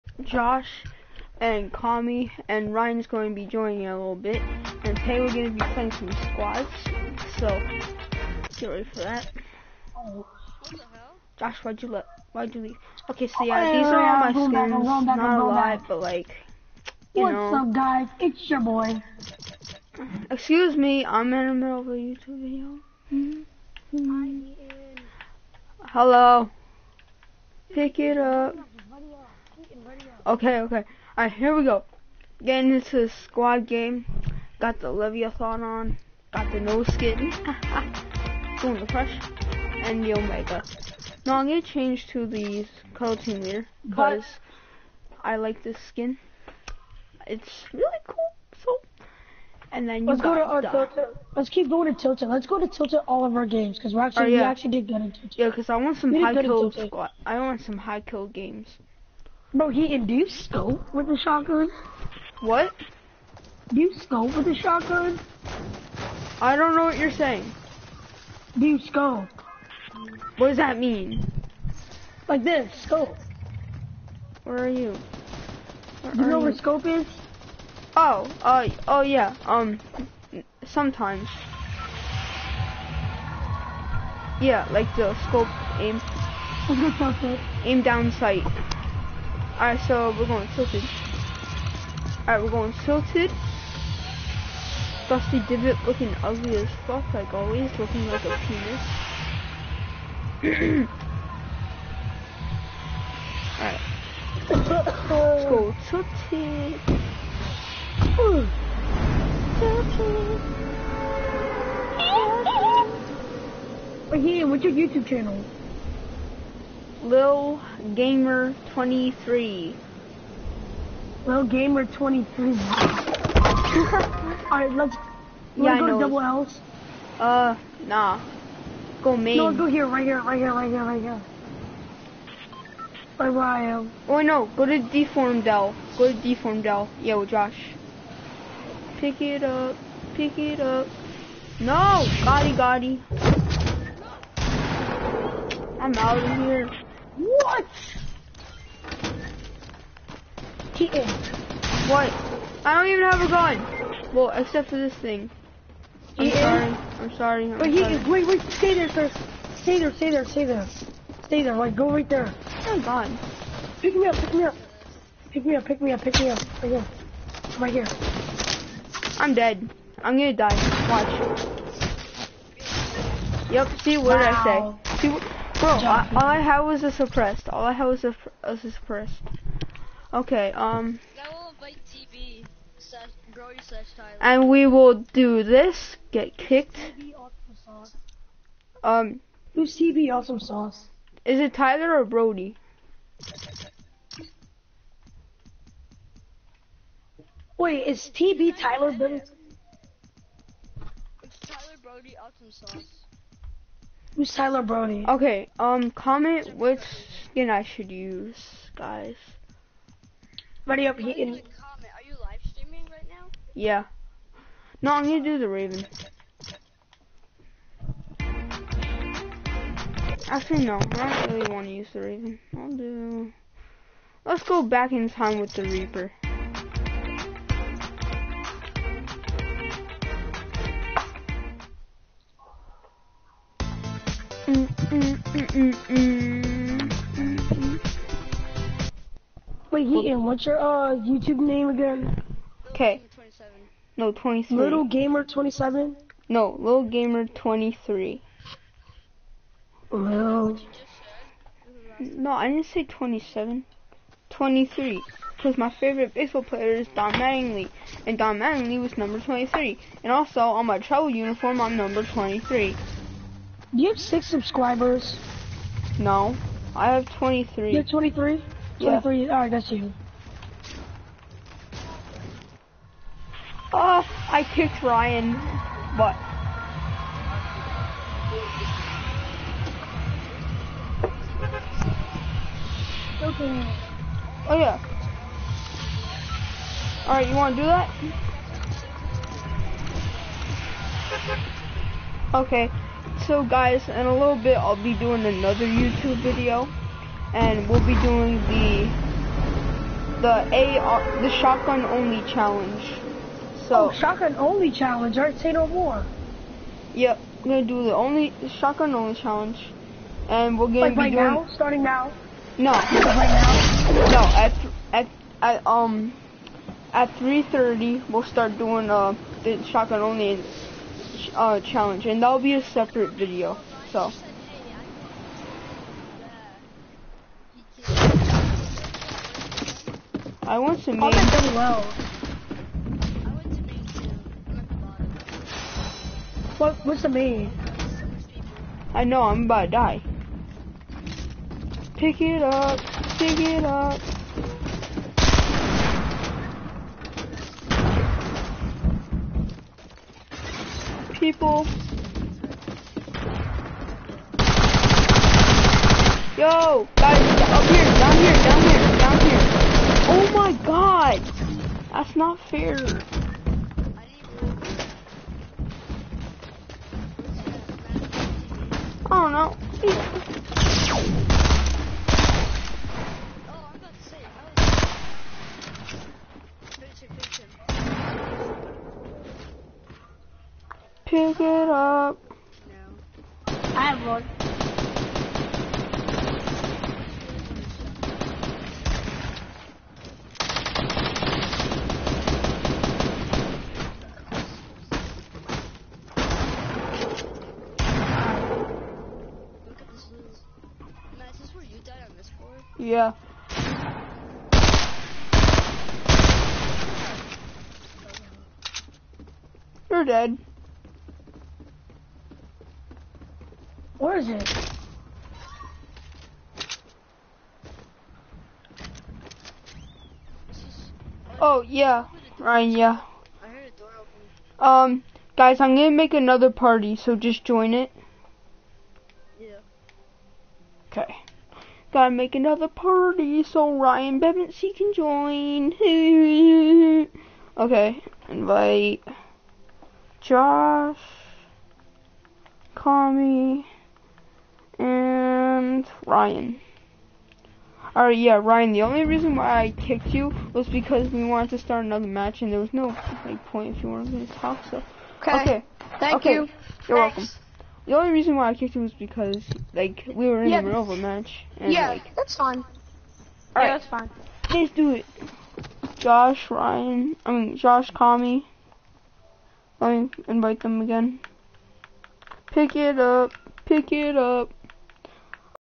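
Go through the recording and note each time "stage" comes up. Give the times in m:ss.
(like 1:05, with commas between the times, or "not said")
not said.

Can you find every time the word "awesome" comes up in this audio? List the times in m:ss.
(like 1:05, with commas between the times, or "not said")
3:10, 3:22.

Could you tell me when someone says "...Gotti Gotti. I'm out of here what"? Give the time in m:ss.
2:22.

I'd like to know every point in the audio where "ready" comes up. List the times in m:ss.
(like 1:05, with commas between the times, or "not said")
0:08, 3:30.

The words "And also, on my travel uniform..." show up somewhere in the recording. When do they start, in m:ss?
4:20.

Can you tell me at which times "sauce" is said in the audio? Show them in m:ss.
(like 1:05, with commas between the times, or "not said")
3:10, 3:22.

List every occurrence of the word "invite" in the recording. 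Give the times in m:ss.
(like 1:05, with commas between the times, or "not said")
7:18, 7:50.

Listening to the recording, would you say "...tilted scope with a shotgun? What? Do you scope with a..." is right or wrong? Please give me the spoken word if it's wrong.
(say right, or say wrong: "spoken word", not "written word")
wrong: "induced", not "tilted".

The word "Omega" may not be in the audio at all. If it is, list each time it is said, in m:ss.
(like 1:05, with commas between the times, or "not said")
0:40.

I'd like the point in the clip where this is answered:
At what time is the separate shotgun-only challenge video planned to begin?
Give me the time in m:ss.
5:17.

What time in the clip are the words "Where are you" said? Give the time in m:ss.
1:14.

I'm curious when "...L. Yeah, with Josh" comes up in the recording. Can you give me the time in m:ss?
2:16.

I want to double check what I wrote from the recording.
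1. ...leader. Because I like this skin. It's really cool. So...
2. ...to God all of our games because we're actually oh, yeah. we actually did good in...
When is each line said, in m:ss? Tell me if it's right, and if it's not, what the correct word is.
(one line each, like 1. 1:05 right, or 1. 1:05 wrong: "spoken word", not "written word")
1. 0:43 right
2. 0:52 wrong: "Tilted", not "God".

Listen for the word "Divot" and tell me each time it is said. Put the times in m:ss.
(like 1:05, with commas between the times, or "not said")
1:35.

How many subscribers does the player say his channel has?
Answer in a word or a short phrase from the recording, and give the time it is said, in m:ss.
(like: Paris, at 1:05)
23, at 4:26.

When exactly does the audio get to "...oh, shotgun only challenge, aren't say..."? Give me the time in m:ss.
5:03.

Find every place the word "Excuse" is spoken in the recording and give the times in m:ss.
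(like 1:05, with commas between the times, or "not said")
0:20.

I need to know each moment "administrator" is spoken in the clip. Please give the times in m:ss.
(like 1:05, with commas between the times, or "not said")
not said.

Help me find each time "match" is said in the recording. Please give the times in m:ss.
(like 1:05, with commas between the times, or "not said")
7:32, 7:40.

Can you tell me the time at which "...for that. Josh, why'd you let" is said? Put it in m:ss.
0:08.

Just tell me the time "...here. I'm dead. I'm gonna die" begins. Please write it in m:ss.
2:47.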